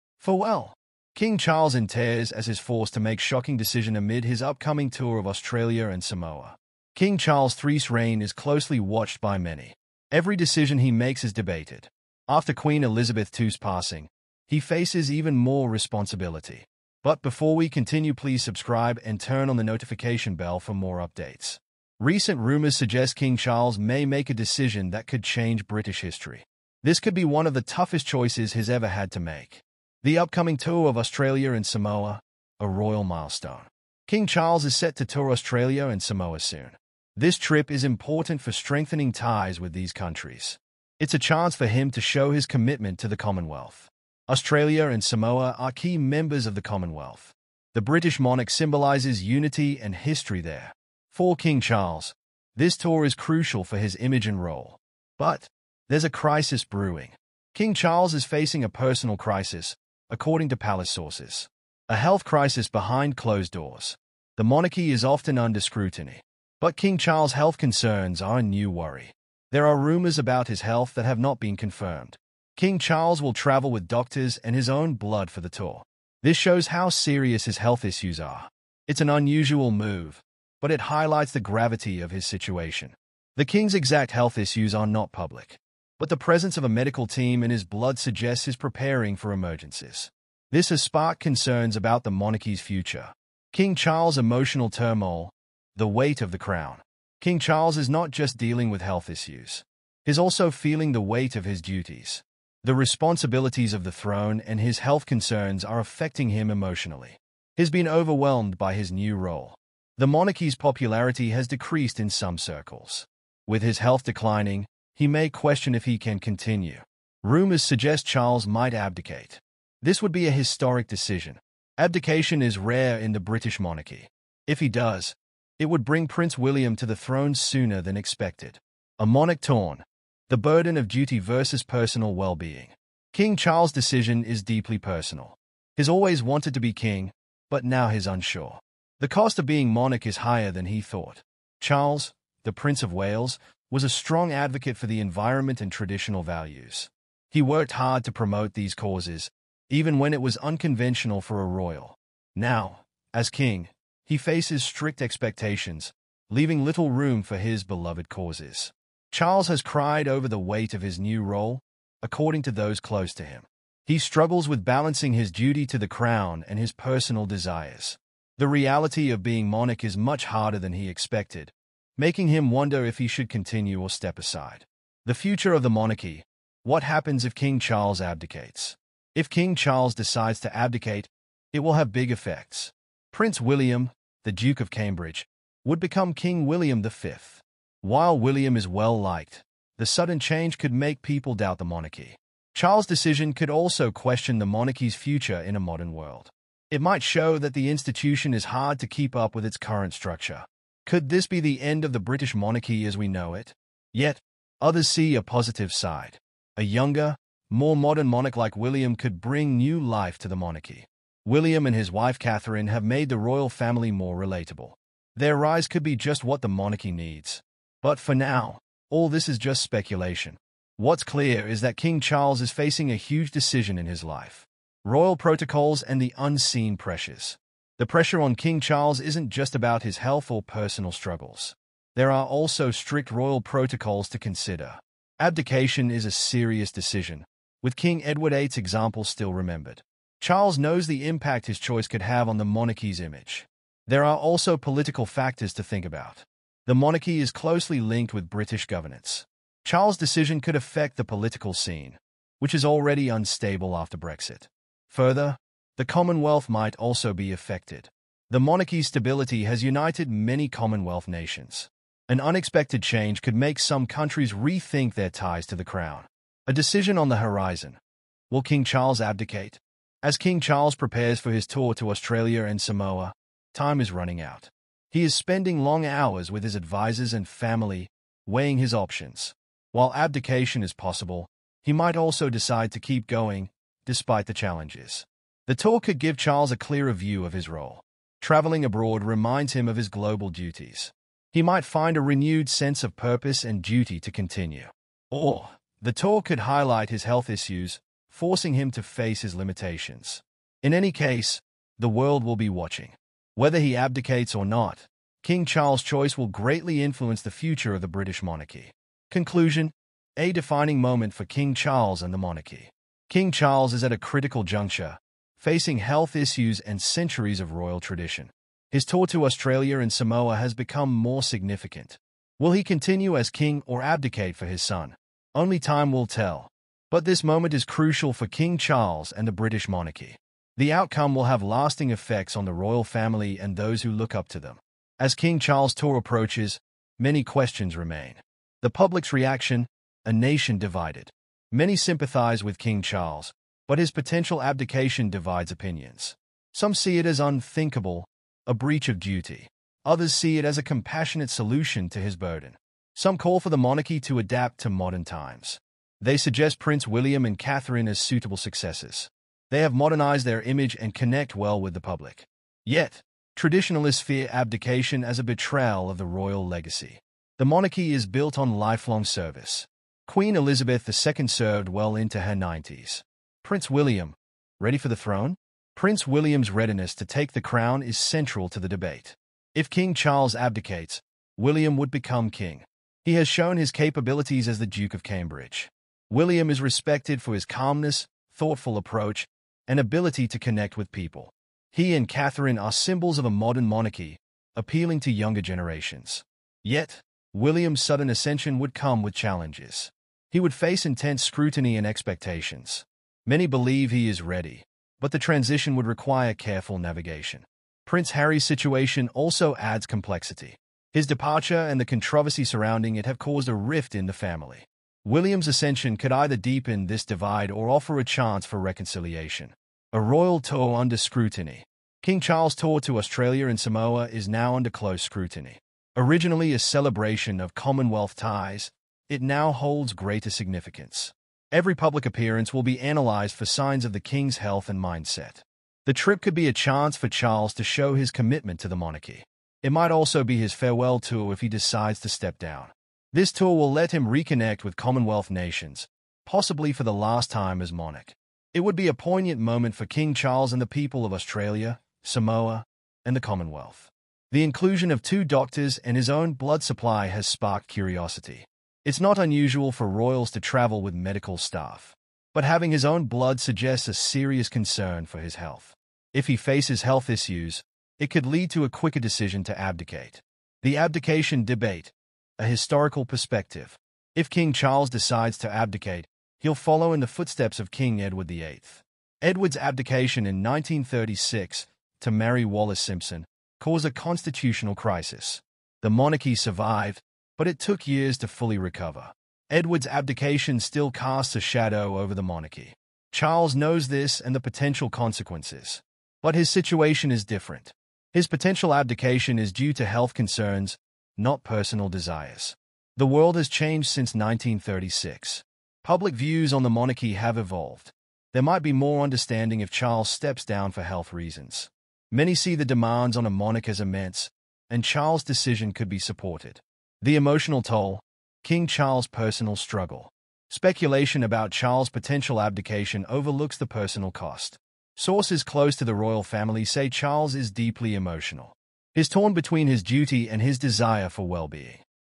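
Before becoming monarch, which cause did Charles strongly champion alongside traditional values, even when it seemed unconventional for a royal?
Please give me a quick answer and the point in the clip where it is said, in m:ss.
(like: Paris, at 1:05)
The environment, at 2:24.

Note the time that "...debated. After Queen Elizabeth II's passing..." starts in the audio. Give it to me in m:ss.
0:11.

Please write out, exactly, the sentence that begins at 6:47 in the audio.
Prince Harry's situation also adds complexity.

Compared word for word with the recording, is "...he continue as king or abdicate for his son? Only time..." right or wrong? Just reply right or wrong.
right.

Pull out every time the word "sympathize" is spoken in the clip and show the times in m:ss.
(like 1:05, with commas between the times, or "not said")
5:41.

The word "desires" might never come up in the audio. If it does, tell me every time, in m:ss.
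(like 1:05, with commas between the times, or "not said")
2:47, 8:21, 8:50.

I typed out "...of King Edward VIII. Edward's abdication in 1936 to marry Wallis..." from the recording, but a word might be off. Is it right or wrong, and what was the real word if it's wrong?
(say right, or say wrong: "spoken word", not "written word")
right.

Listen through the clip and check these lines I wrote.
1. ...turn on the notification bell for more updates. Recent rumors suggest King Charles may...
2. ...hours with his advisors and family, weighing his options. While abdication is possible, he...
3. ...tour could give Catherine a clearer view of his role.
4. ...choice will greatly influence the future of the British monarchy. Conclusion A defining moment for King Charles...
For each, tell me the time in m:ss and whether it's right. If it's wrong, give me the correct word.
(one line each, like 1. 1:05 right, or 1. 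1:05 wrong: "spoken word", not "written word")
1. 0:19 right
2. 4:35 right
3. 4:45 wrong: "Charles", not "Catherine"
4. 5:05 right.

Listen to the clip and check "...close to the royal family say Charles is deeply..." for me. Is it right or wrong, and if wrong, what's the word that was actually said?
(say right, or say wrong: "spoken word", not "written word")
right.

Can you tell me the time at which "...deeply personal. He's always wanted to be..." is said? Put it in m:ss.
2:14.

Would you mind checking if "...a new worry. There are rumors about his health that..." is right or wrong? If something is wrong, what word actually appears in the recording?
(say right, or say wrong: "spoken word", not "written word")
right.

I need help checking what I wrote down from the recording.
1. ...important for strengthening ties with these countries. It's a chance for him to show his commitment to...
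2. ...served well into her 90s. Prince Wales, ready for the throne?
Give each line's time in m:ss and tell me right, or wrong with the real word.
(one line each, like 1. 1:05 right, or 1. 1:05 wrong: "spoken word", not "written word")
1. 0:37 right
2. 6:11 wrong: "William", not "Wales".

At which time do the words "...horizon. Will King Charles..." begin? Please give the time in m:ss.
4:27.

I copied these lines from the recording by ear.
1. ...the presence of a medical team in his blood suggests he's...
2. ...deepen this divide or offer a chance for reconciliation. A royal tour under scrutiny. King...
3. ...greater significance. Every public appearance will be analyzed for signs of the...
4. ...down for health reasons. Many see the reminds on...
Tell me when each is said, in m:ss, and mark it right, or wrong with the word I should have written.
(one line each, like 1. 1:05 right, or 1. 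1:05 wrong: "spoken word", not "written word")
1. 1:26 right
2. 6:56 right
3. 7:09 right
4. 8:30 wrong: "demands", not "reminds".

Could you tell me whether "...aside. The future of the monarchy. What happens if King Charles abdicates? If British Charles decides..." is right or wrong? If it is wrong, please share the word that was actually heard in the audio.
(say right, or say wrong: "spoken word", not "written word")
wrong: "King", not "British".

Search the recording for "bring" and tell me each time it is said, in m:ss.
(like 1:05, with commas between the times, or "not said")
2:05, 3:29.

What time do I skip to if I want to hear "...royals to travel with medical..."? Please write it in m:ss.
7:39.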